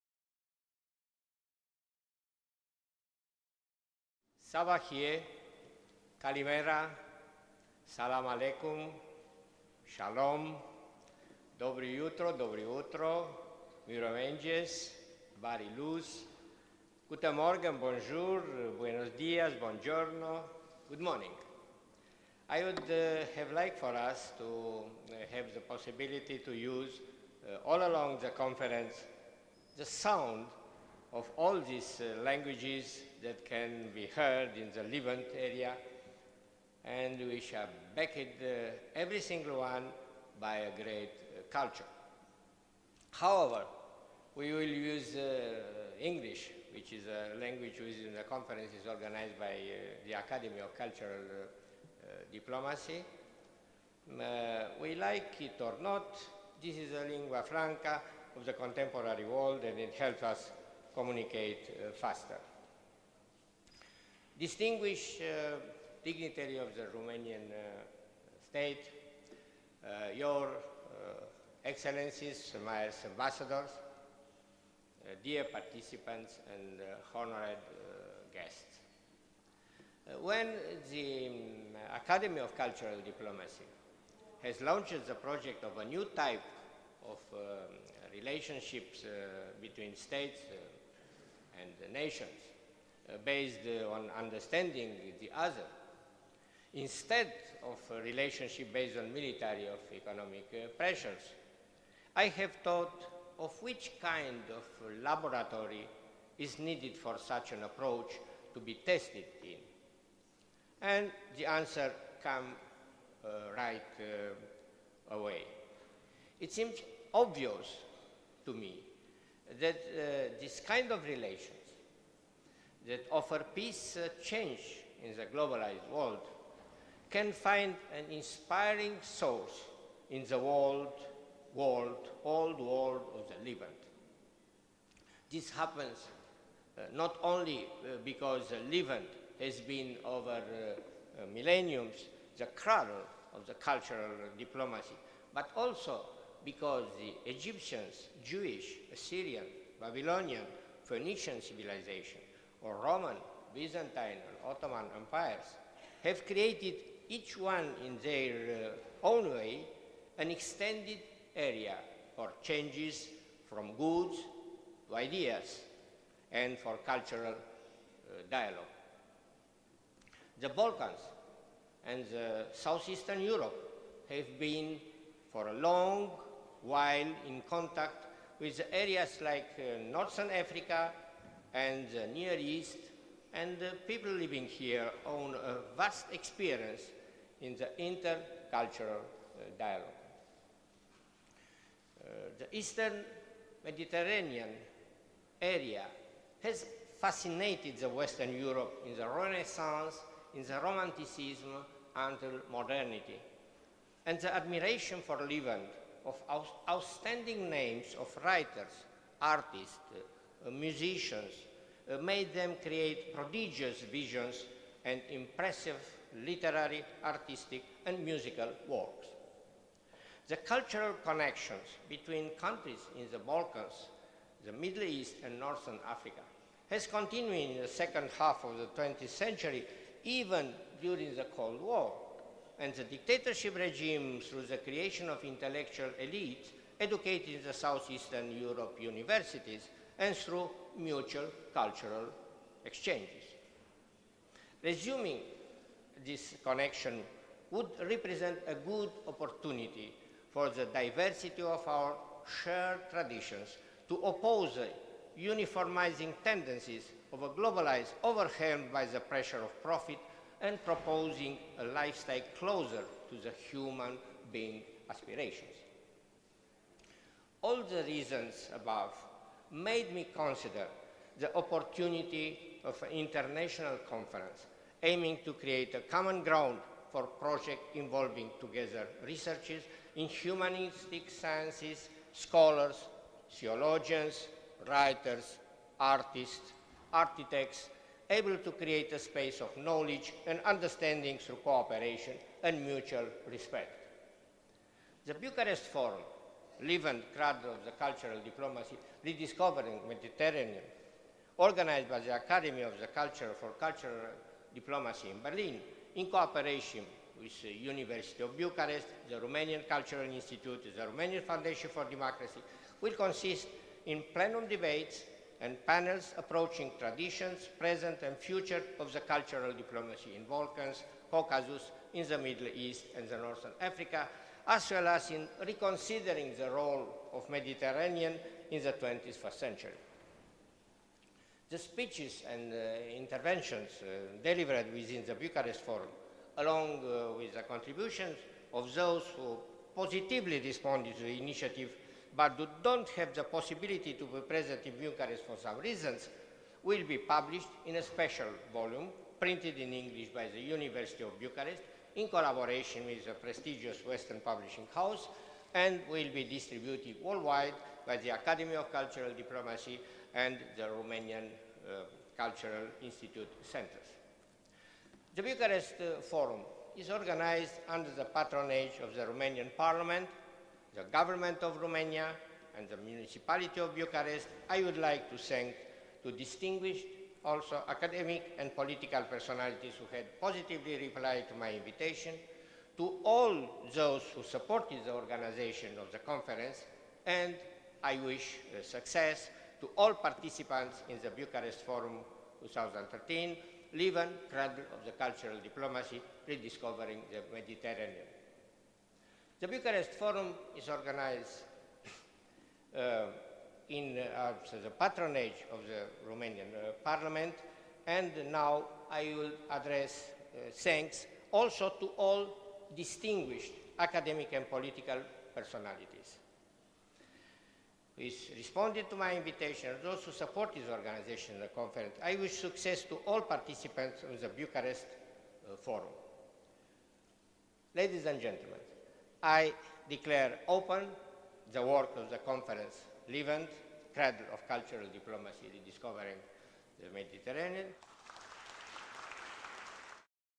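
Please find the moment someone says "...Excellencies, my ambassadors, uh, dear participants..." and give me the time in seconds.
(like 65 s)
71 s.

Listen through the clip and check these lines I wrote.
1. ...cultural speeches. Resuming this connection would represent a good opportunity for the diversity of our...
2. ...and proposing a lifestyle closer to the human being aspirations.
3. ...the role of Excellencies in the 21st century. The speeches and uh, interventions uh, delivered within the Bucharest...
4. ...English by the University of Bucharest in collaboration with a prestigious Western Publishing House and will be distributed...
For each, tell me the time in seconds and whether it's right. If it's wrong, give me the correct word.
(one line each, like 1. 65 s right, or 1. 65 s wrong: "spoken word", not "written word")
1. 241 s wrong: "exchanges", not "speeches"
2. 260 s right
3. 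326 s wrong: "Mediterranean", not "Excellencies"
4. 349 s right.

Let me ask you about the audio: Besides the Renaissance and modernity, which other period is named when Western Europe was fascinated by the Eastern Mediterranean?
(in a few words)
Romanticism.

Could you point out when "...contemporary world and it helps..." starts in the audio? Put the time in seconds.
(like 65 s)
58 s.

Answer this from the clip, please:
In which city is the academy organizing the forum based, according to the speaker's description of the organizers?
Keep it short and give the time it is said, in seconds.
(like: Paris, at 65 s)
Berlin, at 305 s.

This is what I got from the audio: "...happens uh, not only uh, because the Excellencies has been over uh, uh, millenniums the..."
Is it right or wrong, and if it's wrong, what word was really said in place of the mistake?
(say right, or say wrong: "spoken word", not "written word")
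wrong: "Levant", not "Excellencies".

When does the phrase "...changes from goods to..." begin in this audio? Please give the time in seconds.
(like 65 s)
162 s.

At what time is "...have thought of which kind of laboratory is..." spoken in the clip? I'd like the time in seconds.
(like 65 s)
102 s.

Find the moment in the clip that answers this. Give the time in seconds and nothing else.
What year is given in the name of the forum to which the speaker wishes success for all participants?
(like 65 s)
392 s.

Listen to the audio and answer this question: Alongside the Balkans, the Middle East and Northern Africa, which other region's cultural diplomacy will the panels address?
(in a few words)
Caucasus.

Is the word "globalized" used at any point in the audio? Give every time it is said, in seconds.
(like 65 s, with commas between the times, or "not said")
125 s, 257 s.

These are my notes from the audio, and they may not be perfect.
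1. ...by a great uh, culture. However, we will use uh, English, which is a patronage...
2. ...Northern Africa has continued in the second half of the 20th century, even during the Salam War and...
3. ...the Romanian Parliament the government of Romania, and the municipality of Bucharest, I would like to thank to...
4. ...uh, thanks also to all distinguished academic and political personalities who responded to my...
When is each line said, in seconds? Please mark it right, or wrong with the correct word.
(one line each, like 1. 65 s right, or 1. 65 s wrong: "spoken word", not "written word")
1. 40 s wrong: "language", not "patronage"
2. 225 s wrong: "Cold", not "Salam"
3. 368 s right
4. 410 s right.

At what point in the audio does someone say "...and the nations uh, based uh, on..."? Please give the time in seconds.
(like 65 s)
91 s.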